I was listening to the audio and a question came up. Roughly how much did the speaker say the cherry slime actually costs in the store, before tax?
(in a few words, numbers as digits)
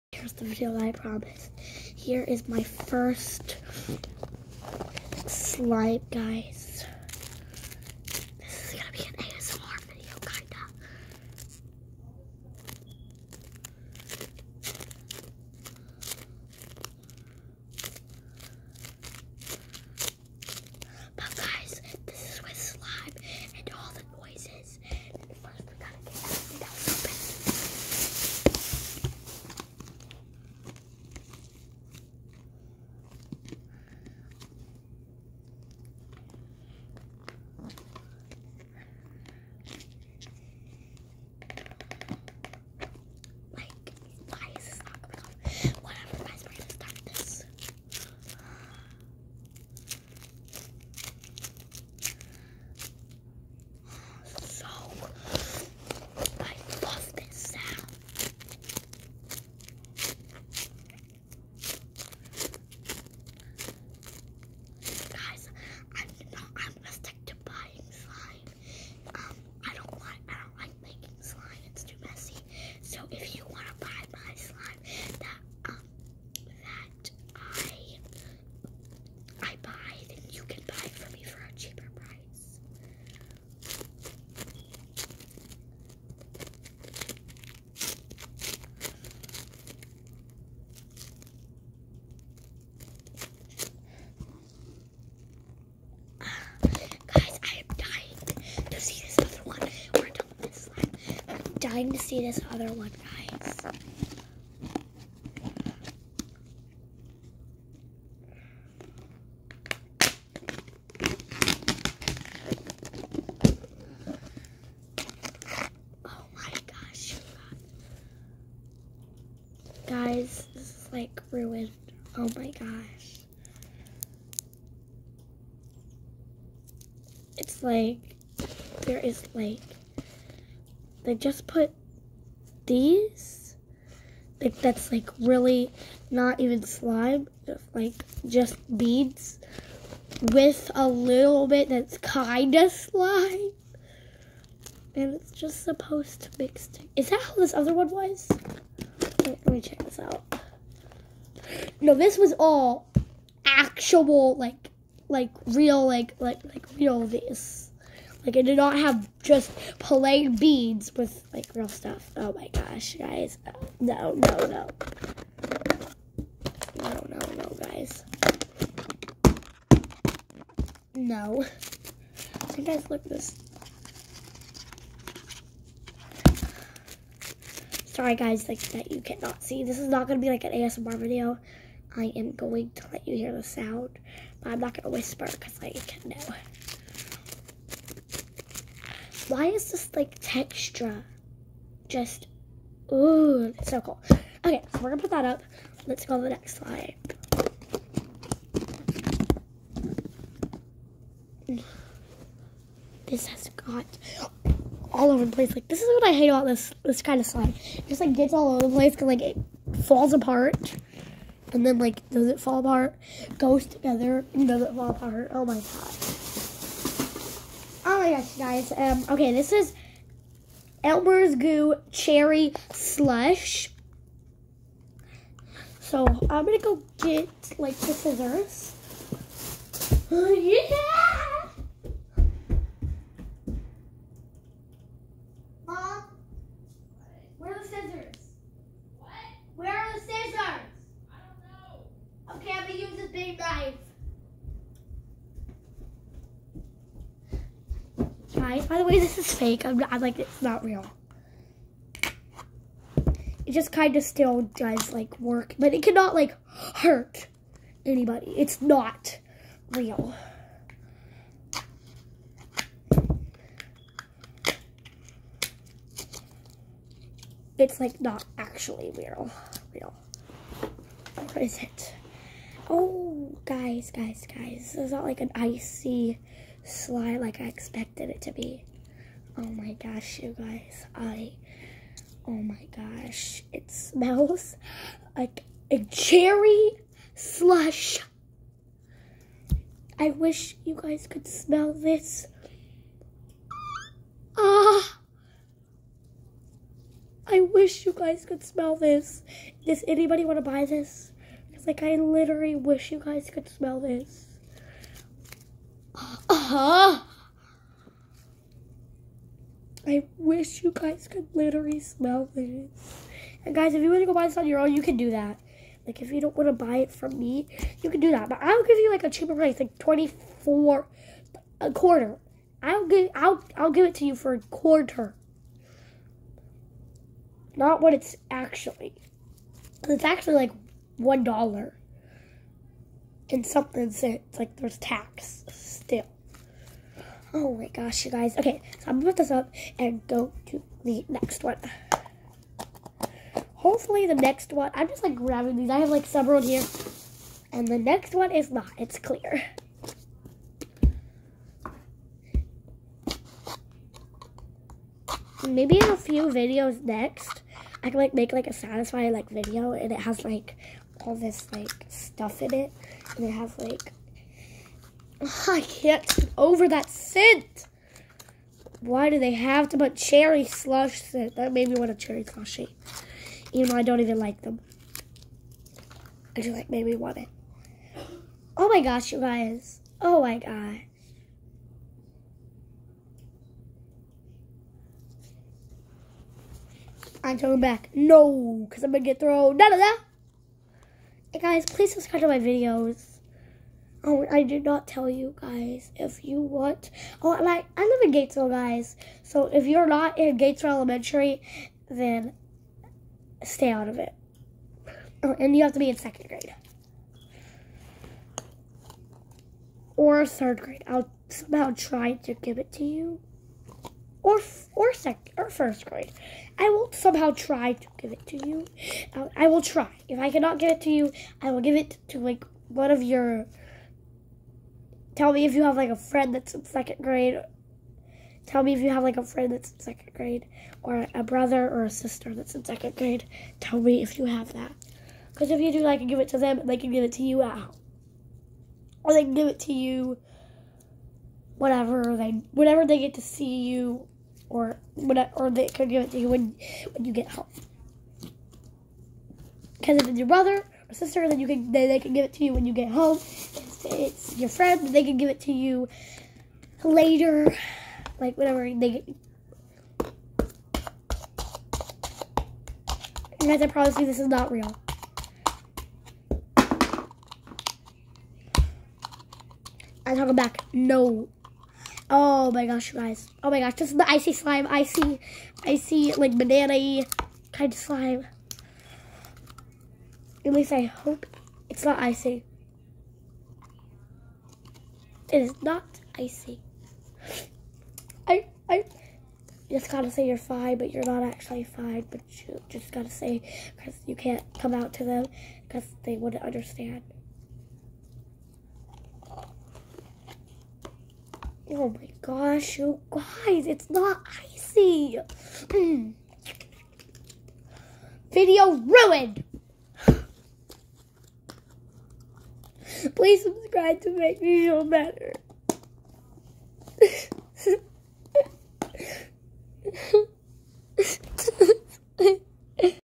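$1.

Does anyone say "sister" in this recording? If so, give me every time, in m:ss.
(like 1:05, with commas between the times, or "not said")
7:11, 7:30.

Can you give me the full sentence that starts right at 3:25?
Like this is what I hate about this this kind of slide.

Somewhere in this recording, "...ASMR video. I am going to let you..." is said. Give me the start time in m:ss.
3:00.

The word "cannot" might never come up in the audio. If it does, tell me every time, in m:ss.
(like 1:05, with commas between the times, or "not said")
2:59, 4:15, 7:00.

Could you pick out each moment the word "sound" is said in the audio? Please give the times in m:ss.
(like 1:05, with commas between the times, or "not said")
3:03.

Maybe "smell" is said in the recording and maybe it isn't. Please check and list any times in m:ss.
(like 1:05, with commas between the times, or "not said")
4:43, 4:51, 4:58, 5:03, 5:11.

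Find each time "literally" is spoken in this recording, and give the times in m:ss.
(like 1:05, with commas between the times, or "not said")
5:01, 5:11.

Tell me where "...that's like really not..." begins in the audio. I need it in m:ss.
2:14.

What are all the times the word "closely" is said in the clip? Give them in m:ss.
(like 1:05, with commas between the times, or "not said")
not said.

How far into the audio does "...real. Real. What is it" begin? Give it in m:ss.
4:28.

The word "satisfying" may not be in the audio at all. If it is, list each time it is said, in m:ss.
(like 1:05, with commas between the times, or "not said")
5:58.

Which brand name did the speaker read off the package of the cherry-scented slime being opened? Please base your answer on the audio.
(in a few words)
Elmer's.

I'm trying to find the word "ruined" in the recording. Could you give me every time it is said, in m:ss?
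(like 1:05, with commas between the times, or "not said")
2:01, 8:28.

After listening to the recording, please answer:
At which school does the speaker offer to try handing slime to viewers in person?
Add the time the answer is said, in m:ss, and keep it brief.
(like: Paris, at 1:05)
Gatesville Elementary, at 6:40.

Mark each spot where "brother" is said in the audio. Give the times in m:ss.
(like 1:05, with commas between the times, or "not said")
7:11, 7:30.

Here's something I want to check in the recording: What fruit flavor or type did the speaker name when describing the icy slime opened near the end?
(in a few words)
banana.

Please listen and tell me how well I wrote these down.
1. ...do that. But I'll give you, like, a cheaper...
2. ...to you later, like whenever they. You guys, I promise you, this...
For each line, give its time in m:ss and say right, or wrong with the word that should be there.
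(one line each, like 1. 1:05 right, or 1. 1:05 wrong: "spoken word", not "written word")
1. 5:17 right
2. 7:35 right.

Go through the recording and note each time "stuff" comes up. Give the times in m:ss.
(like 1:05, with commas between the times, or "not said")
2:41, 6:01.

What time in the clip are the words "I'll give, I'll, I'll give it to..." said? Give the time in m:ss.
5:22.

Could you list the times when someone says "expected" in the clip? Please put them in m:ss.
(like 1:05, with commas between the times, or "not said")
4:37.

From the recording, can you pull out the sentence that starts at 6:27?
No, because I'm going to get thrown.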